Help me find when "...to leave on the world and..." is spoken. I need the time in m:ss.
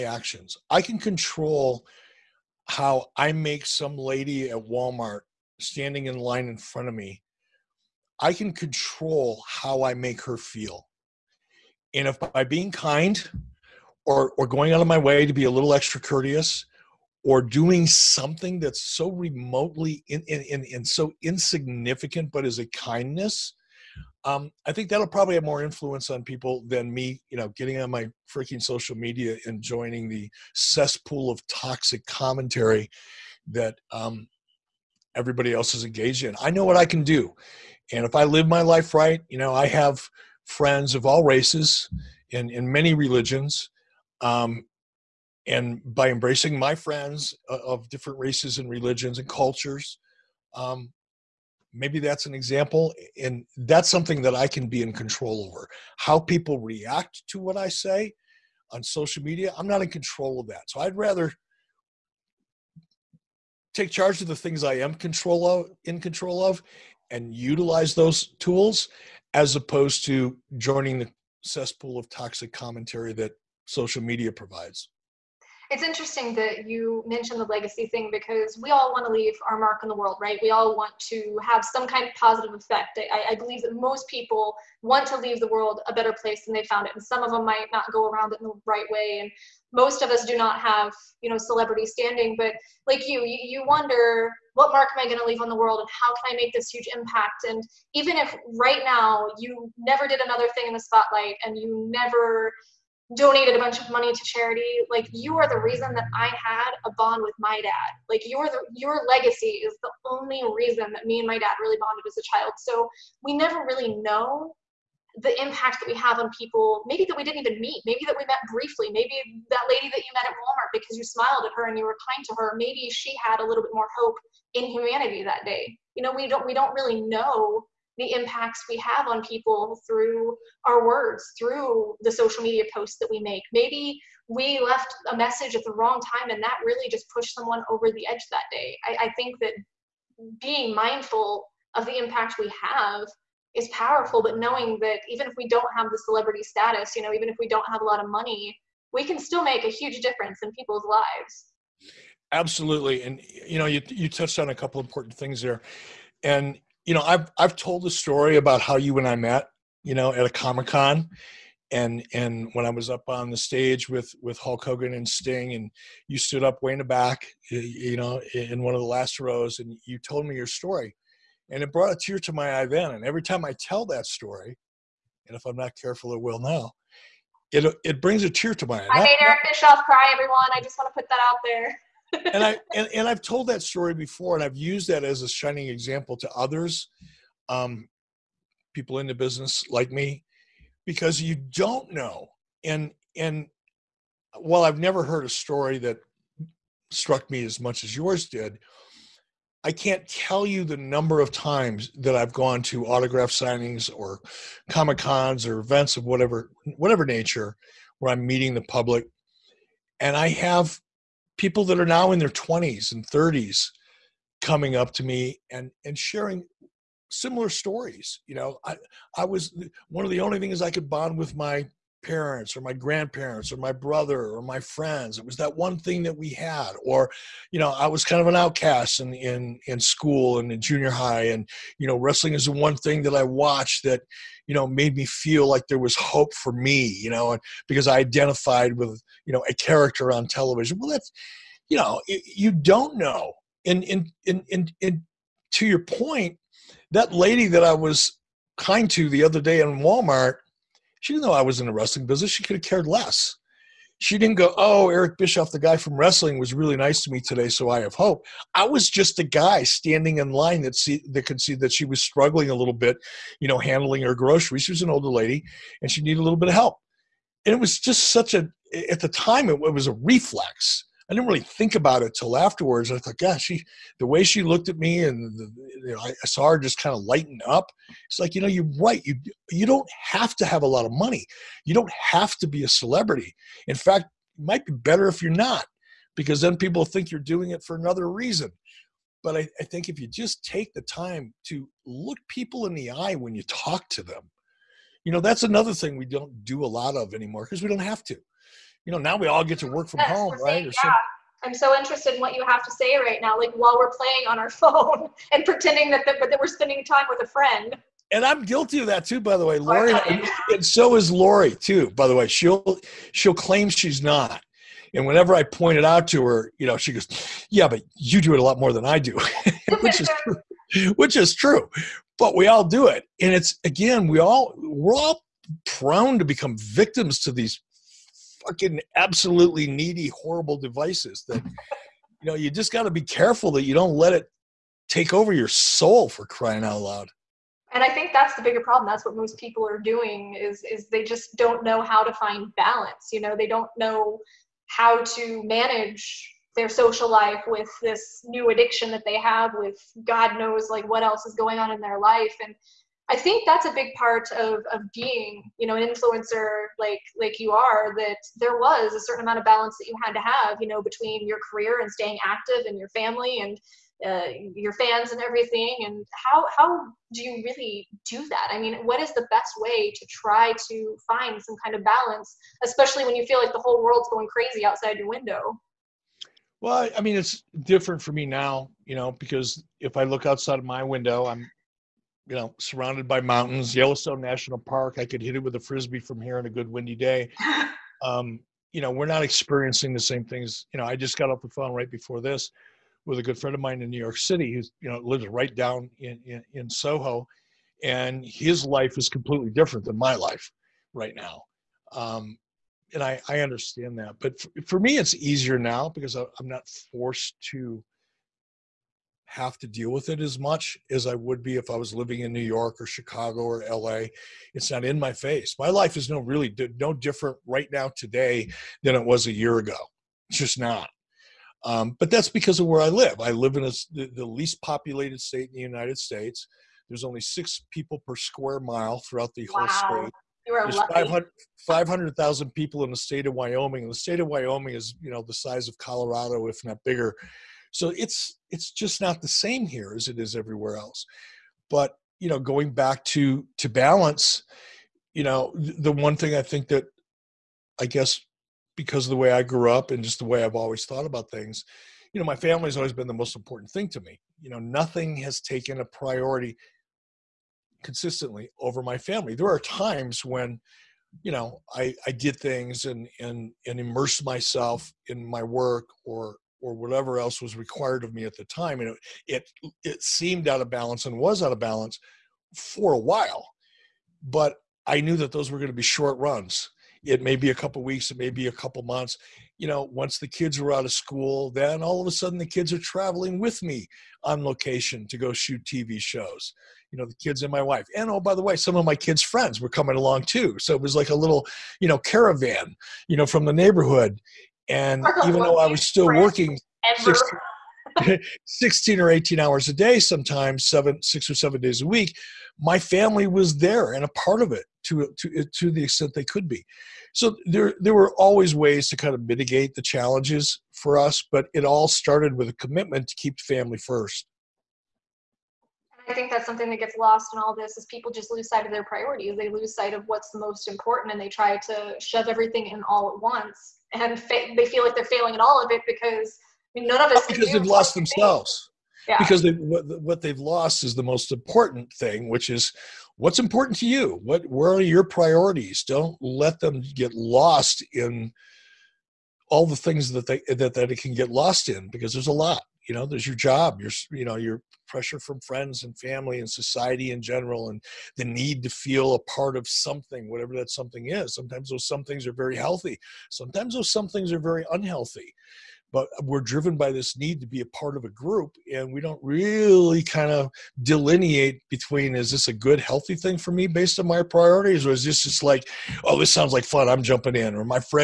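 1:35.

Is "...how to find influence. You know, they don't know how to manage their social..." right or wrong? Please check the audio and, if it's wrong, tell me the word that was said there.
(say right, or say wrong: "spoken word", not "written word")
wrong: "balance", not "influence".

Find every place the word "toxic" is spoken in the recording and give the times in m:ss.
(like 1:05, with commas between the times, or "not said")
0:31, 1:12.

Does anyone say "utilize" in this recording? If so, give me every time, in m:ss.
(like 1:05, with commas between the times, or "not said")
1:07.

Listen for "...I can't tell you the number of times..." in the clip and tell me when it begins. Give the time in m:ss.
3:19.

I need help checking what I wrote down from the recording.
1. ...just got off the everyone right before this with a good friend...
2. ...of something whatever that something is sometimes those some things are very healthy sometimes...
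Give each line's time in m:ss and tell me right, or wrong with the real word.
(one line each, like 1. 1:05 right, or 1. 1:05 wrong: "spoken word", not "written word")
1. 6:30 wrong: "phone", not "everyone"
2. 9:09 right.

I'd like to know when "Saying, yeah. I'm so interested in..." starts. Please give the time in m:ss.
5:00.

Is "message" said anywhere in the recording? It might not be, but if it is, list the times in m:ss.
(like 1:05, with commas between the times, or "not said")
2:15.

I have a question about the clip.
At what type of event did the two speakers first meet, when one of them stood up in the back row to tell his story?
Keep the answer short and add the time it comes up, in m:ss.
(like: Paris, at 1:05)
Comic Con, at 2:40.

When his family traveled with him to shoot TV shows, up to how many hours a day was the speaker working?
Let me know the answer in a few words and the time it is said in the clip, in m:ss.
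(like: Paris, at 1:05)
18, at 8:19.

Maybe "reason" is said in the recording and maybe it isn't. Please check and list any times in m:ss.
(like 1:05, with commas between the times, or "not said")
1:45, 1:50, 4:48.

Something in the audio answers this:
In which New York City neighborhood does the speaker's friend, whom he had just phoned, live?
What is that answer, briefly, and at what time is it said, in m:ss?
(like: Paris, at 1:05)
Soho, at 6:36.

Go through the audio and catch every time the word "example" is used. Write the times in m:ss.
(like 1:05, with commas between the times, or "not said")
0:52, 3:05.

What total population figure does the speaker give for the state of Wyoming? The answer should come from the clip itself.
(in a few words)
500,000.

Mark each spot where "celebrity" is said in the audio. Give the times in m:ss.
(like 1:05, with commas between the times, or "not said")
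1:31, 2:26, 4:42.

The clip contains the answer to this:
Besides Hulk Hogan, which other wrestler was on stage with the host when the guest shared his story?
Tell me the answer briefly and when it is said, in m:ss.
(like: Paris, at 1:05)
Sting, at 2:45.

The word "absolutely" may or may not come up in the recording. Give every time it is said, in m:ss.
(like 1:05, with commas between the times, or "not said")
2:32, 5:28.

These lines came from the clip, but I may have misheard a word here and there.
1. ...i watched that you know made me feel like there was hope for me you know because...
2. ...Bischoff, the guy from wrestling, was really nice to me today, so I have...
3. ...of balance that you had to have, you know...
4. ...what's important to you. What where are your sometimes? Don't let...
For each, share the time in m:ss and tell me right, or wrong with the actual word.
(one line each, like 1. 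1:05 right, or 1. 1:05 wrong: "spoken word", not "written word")
1. 3:53 right
2. 4:15 right
3. 5:59 right
4. 8:53 wrong: "priorities", not "sometimes".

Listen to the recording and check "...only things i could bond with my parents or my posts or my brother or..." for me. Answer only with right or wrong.
wrong.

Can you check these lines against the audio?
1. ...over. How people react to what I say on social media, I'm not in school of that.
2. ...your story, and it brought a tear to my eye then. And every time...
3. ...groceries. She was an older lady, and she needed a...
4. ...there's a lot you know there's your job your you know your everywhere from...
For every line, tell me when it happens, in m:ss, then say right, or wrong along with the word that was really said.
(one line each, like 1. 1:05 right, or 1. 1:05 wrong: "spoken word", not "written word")
1. 0:55 wrong: "control", not "school"
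2. 2:50 right
3. 4:24 right
4. 9:02 wrong: "pressure", not "everywhere".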